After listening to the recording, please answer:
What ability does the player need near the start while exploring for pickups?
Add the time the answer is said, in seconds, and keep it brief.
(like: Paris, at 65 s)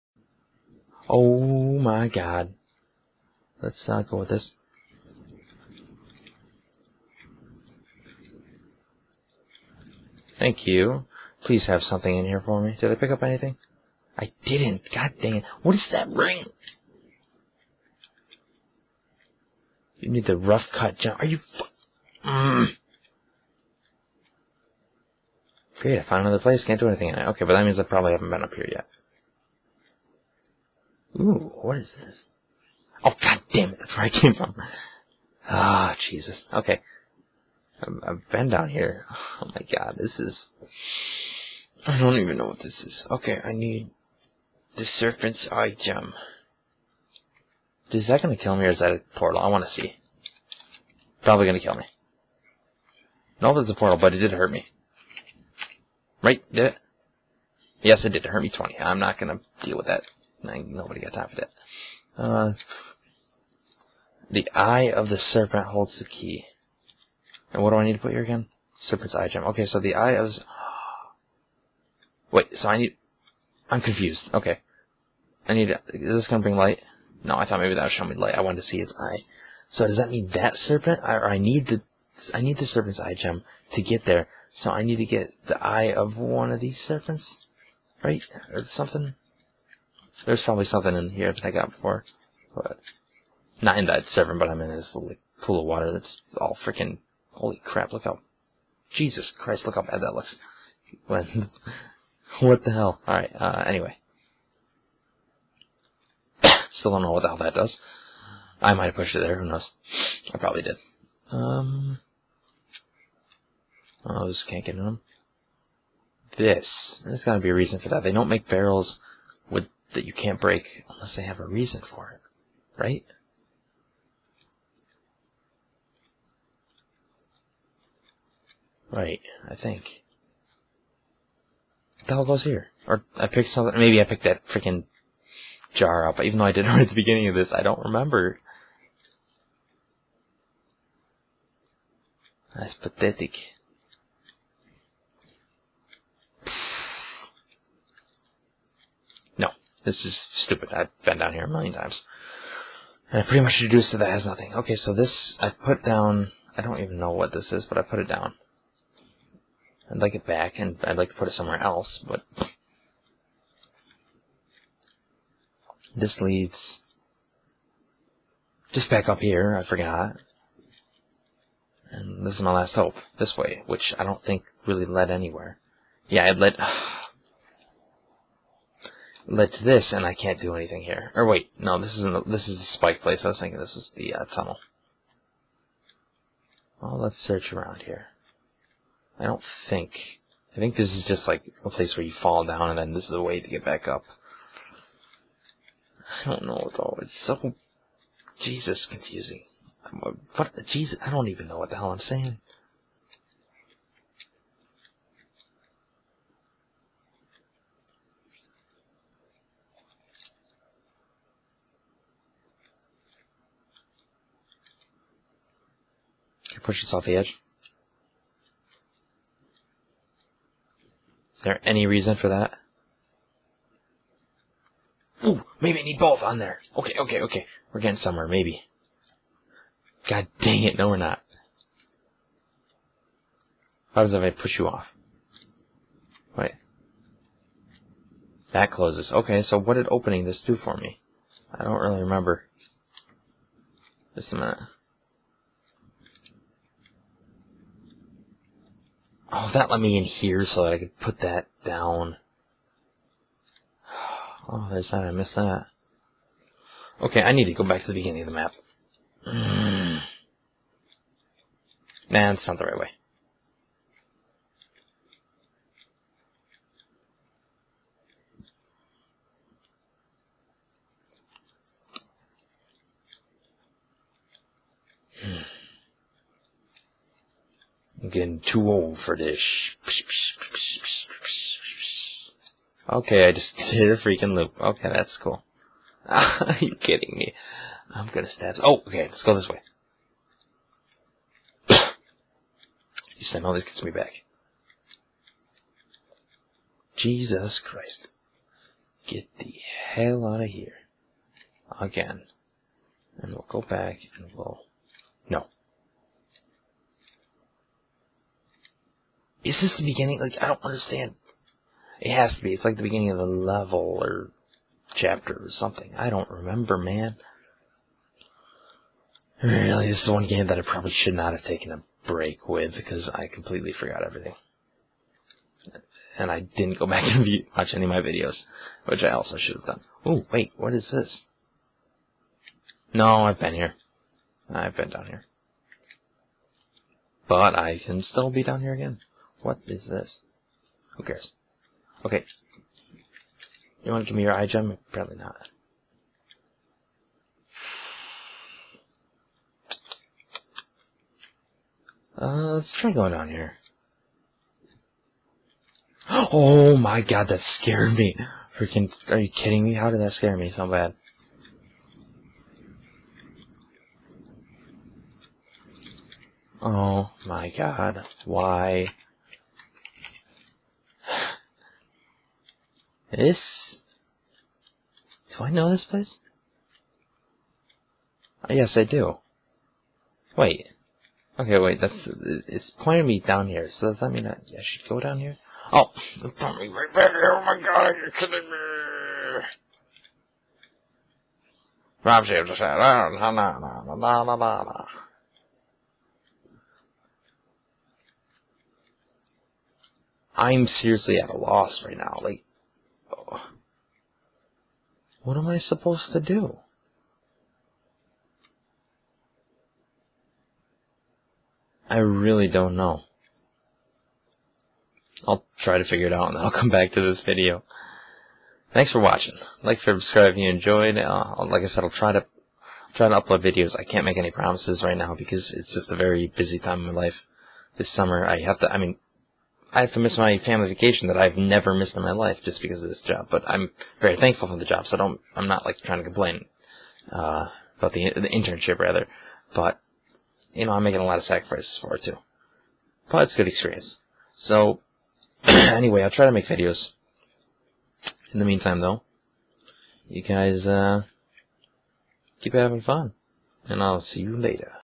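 rough cut jump, at 20 s.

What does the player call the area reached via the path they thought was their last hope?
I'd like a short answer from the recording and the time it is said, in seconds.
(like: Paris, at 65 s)
the spike place, at 182 s.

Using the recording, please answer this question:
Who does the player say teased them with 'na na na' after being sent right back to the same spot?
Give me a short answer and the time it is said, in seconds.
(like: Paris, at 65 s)
Rob, at 392 s.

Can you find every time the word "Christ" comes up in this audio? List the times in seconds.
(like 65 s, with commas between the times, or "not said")
99 s, 297 s.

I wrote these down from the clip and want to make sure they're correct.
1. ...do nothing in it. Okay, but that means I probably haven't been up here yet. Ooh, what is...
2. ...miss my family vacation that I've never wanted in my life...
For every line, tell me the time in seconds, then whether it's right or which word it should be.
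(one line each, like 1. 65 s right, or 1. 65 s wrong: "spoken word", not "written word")
1. 26 s wrong: "anything", not "nothing"
2. 430 s wrong: "missed", not "wanted".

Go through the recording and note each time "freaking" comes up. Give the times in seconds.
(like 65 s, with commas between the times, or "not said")
96 s, 134 s, 283 s, 358 s.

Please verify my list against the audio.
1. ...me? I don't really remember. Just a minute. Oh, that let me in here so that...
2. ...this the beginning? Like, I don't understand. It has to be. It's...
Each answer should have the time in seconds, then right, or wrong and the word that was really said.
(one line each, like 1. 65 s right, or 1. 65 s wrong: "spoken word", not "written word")
1. 240 s right
2. 309 s right.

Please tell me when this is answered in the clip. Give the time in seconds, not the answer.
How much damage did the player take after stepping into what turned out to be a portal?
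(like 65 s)
58 s.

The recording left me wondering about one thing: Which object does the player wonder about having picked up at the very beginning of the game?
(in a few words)
jar.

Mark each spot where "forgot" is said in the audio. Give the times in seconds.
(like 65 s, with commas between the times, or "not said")
169 s, 323 s.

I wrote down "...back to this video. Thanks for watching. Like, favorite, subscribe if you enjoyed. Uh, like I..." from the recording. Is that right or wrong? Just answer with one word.
right.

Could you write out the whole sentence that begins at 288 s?
Oh, okay, let's go this way.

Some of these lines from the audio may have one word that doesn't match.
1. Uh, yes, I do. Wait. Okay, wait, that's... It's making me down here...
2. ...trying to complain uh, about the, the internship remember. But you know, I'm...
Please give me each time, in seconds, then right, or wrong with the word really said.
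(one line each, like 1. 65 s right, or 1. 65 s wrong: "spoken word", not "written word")
1. 378 s wrong: "pointing", not "making"
2. 435 s wrong: "rather", not "remember".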